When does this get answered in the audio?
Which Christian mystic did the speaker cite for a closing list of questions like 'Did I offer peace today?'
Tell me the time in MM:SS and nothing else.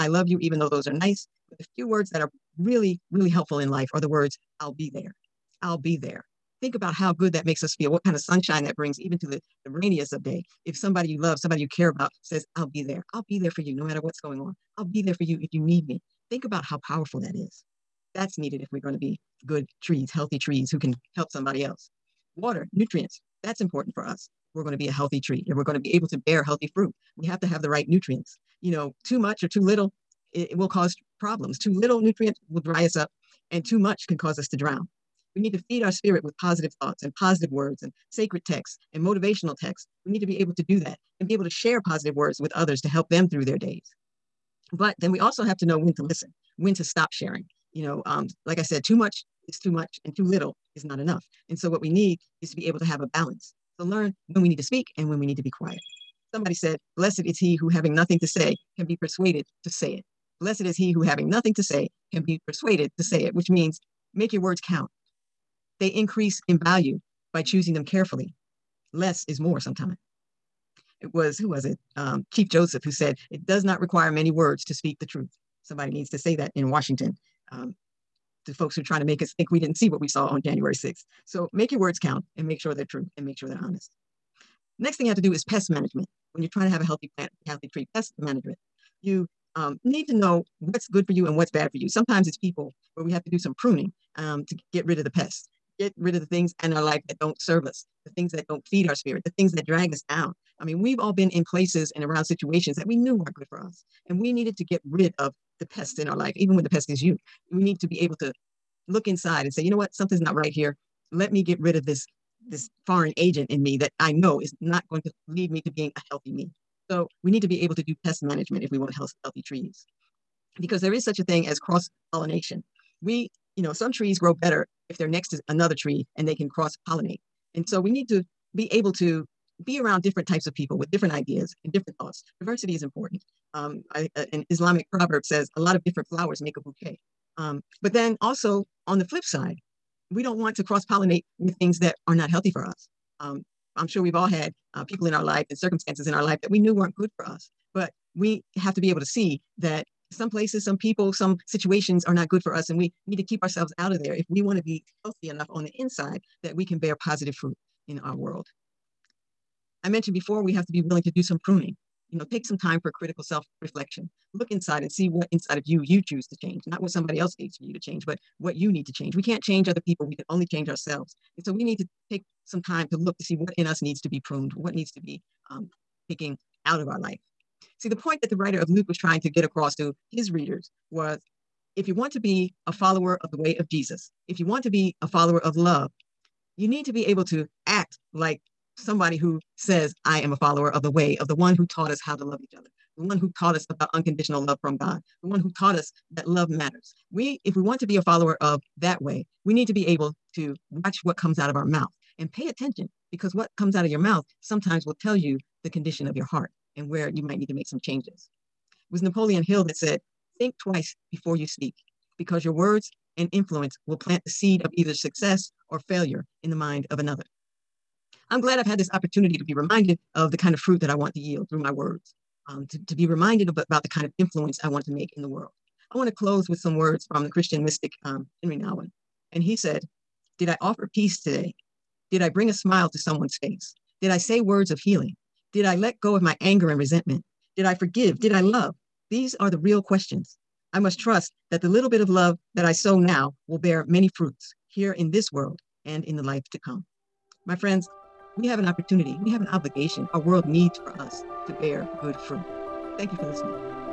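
03:48.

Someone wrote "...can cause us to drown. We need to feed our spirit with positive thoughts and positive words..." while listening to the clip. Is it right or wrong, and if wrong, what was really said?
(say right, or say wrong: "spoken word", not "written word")
right.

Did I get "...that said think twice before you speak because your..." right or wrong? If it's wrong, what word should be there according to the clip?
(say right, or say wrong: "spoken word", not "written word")
right.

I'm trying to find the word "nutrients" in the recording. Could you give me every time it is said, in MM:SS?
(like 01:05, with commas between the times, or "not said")
00:22, 00:27, 00:32.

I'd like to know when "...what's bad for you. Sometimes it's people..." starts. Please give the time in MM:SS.
01:31.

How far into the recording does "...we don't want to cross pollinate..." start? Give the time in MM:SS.
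02:20.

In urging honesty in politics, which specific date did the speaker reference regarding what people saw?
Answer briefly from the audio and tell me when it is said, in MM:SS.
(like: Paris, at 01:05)
January 6th, at 01:20.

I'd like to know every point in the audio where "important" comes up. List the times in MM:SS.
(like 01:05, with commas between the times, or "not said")
00:23, 02:12.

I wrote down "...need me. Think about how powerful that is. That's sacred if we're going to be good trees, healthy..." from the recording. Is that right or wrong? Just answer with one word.
wrong.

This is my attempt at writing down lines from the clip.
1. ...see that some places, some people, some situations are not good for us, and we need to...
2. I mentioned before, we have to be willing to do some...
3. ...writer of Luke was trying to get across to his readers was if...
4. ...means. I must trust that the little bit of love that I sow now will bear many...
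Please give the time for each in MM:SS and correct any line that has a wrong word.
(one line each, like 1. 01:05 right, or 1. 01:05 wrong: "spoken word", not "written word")
1. 02:29 right
2. 02:39 right
3. 02:58 right
4. 03:59 wrong: "questions", not "means".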